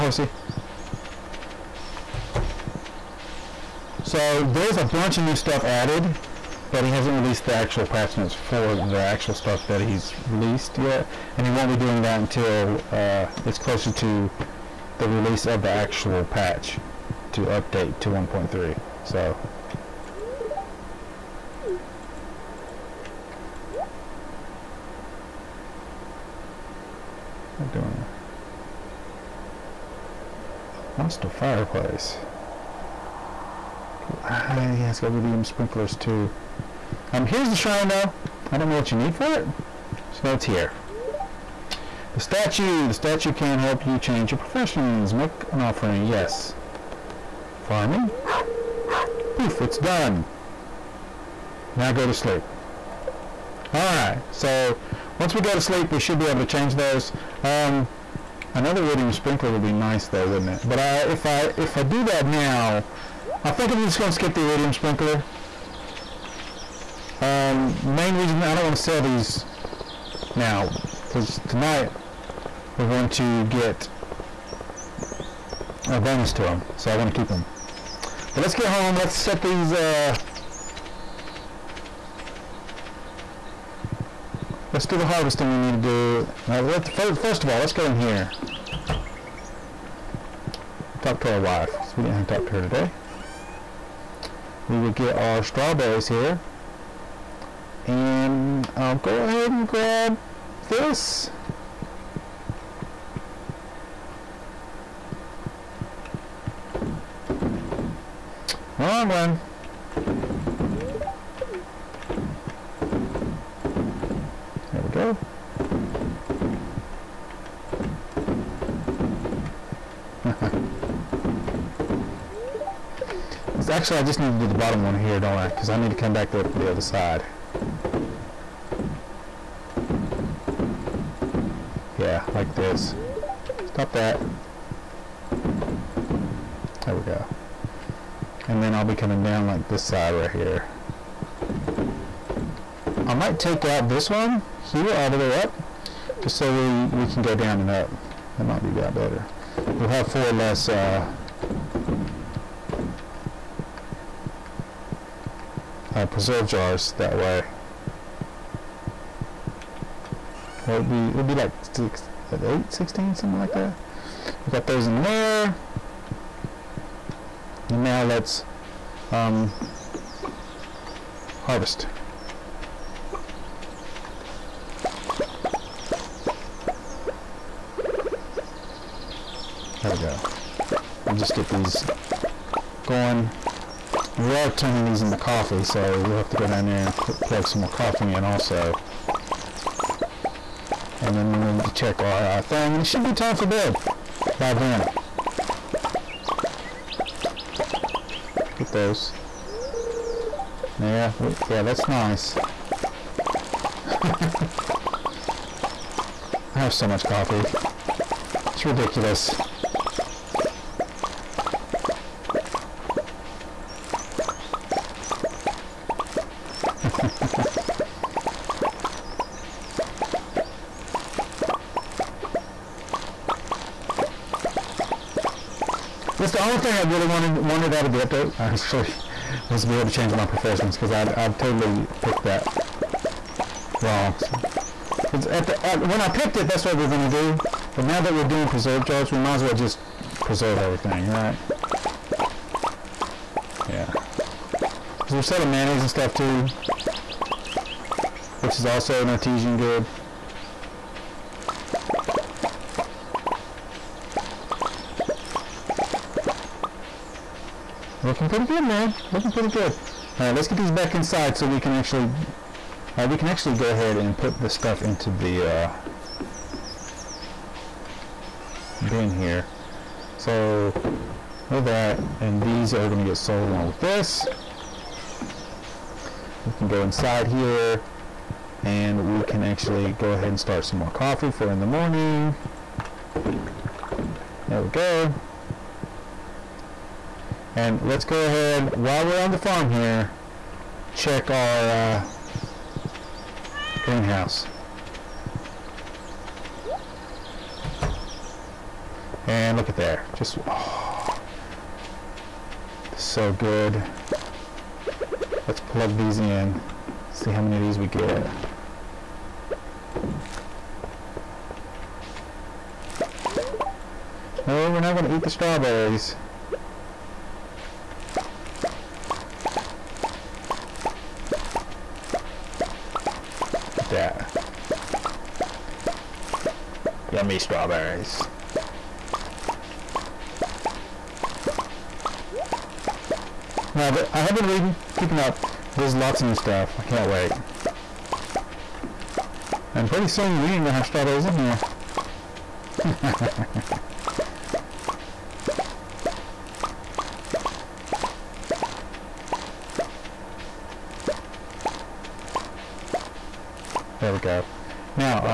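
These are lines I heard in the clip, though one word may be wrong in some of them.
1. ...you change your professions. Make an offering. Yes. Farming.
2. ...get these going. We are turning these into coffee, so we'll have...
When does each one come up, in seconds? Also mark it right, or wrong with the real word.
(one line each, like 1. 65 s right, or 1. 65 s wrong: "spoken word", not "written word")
1. 43 s right
2. 181 s right.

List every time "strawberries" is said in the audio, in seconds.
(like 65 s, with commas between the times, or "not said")
95 s, 315 s, 327 s, 340 s.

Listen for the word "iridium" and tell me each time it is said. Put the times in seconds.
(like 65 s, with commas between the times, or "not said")
58 s, 64 s.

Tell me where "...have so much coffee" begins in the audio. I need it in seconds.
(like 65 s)
206 s.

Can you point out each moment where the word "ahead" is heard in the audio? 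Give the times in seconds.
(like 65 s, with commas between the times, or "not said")
99 s, 263 s, 280 s, 288 s.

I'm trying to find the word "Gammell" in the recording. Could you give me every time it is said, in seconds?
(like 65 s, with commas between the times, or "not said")
not said.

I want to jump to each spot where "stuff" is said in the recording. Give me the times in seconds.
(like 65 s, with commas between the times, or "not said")
5 s, 9 s, 245 s, 264 s, 336 s.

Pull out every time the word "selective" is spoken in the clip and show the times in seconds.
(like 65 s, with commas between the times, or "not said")
not said.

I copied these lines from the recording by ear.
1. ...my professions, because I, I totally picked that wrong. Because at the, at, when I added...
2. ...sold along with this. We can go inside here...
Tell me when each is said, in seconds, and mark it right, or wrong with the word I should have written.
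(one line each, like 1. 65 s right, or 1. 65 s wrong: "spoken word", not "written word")
1. 230 s wrong: "picked", not "added"
2. 273 s right.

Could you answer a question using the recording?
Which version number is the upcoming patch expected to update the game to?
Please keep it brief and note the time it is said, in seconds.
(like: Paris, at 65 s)
1.3, at 18 s.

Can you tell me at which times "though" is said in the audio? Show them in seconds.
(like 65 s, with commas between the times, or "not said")
37 s, 60 s.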